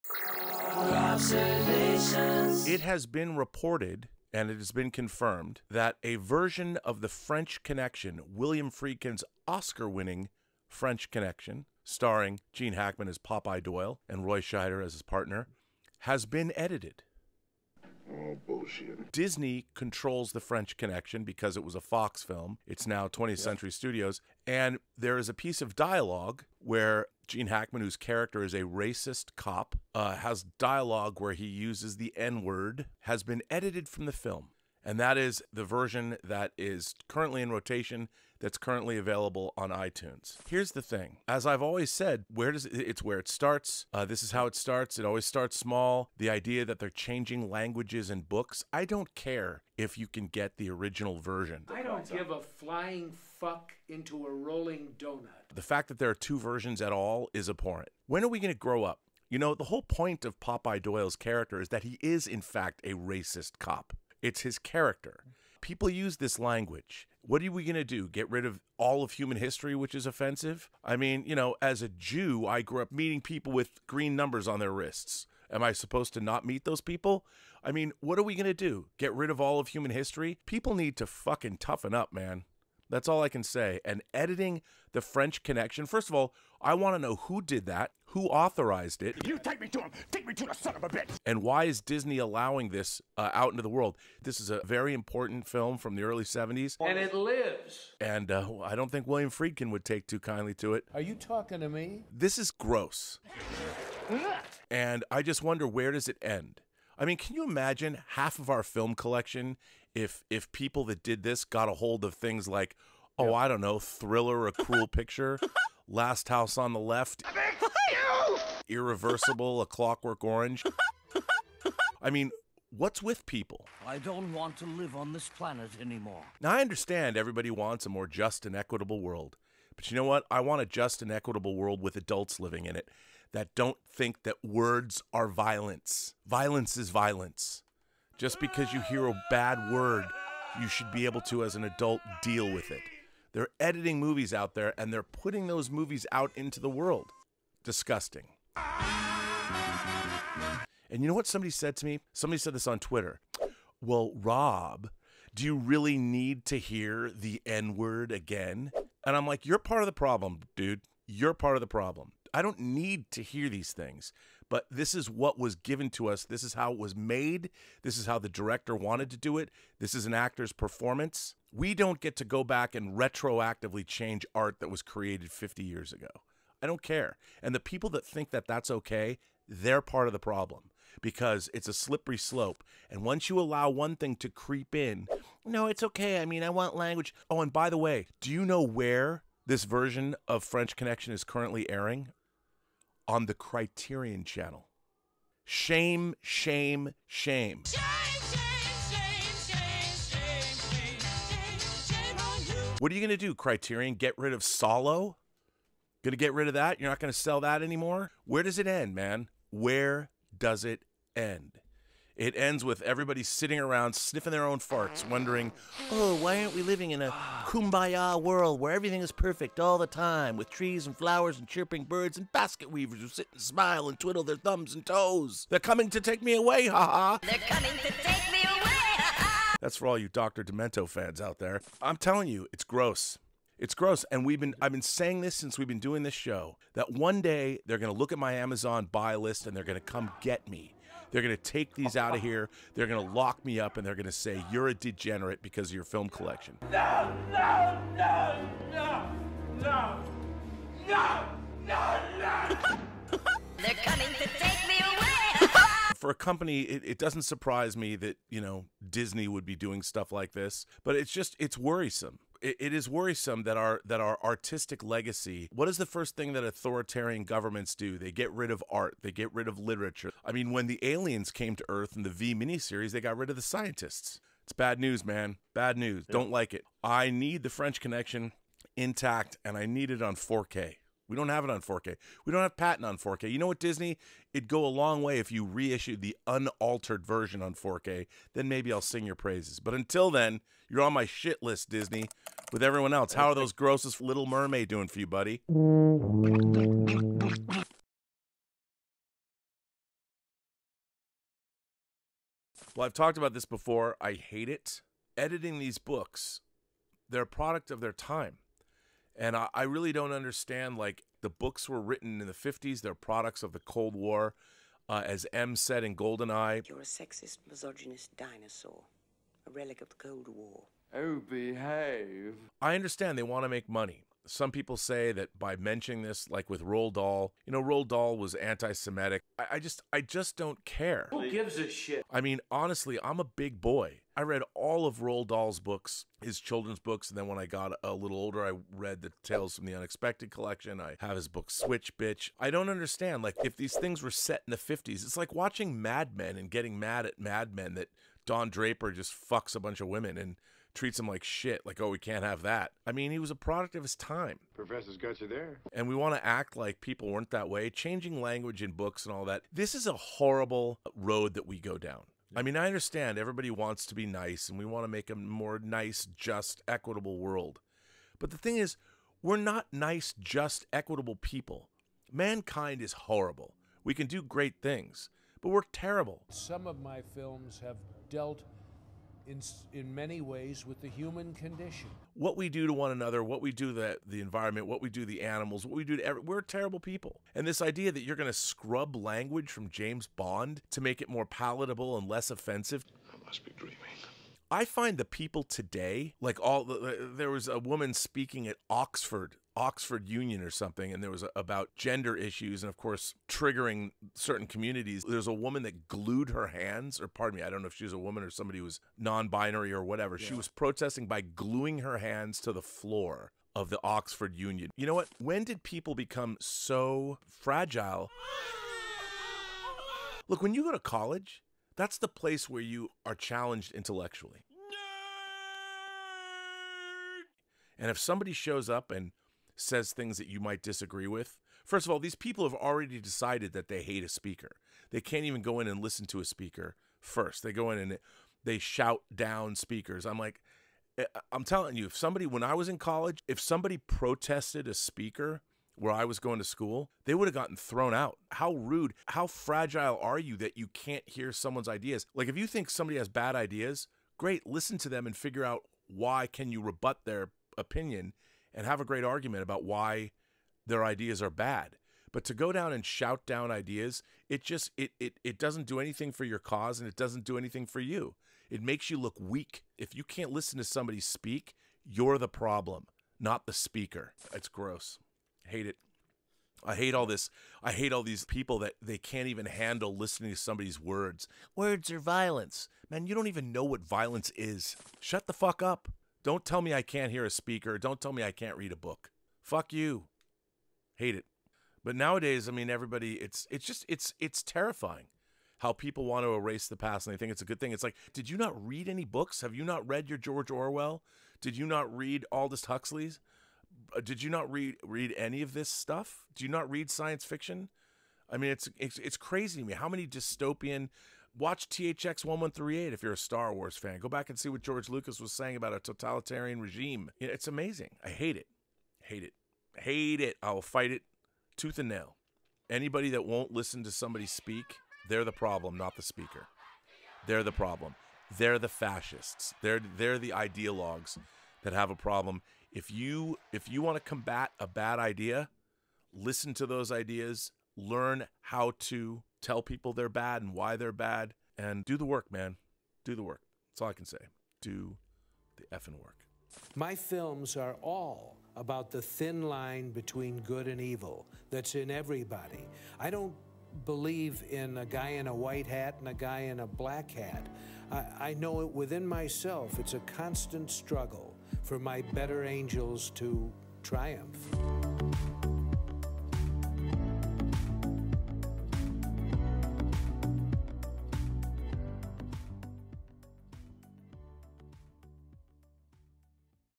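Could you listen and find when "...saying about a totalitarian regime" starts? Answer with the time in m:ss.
8:35.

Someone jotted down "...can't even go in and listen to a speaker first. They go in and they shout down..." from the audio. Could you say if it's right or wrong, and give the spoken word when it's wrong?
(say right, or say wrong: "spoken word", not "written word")
right.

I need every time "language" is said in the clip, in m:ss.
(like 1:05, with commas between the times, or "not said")
0:47, 1:06, 3:06, 5:58, 6:28.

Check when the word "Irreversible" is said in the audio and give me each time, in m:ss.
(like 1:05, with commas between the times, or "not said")
1:58.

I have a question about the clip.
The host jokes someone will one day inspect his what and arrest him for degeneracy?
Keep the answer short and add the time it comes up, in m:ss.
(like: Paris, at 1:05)
Amazon buy list, at 3:58.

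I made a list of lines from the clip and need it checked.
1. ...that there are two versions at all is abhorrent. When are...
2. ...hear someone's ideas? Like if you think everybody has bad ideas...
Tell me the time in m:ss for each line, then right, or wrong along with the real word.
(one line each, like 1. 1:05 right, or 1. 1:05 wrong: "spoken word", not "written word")
1. 0:55 right
2. 7:31 wrong: "somebody", not "everybody".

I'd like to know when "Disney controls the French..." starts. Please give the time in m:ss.
0:19.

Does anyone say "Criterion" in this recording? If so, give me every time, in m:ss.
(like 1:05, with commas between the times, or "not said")
3:13, 3:23.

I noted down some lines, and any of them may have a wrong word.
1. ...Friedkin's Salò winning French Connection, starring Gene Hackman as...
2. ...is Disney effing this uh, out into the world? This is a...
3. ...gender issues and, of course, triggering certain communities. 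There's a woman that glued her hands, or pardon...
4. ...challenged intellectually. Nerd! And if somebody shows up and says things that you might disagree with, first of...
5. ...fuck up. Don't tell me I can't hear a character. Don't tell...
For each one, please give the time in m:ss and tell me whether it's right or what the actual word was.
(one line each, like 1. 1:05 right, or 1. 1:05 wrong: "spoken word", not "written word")
1. 0:08 wrong: "Oscar", not "Salò"
2. 1:31 wrong: "allowing", not "effing"
3. 6:41 right
4. 7:03 right
5. 8:05 wrong: "speaker", not "character".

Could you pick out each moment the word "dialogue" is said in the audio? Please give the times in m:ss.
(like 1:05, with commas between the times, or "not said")
0:25, 0:30.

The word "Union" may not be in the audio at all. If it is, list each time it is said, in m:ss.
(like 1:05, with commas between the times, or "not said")
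6:40, 6:54.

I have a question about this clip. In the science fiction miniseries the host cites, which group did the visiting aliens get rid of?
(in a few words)
the scientists.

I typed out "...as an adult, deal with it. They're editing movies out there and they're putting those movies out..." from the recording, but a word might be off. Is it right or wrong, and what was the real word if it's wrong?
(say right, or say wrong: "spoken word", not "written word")
right.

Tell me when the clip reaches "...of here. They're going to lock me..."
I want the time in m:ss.
4:02.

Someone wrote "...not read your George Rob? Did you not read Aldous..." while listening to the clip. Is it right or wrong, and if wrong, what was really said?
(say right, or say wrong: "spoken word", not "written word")
wrong: "Orwell", not "Rob".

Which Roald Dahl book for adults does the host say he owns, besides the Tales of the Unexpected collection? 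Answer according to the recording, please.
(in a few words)
Switch Bitch.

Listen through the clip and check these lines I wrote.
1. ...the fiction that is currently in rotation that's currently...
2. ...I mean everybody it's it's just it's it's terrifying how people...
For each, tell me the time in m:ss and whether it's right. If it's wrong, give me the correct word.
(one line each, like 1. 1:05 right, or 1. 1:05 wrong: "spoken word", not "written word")
1. 0:35 wrong: "version", not "fiction"
2. 8:12 right.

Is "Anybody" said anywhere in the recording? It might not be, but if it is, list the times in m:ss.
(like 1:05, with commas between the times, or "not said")
8:42.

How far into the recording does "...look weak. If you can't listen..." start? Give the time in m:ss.
7:48.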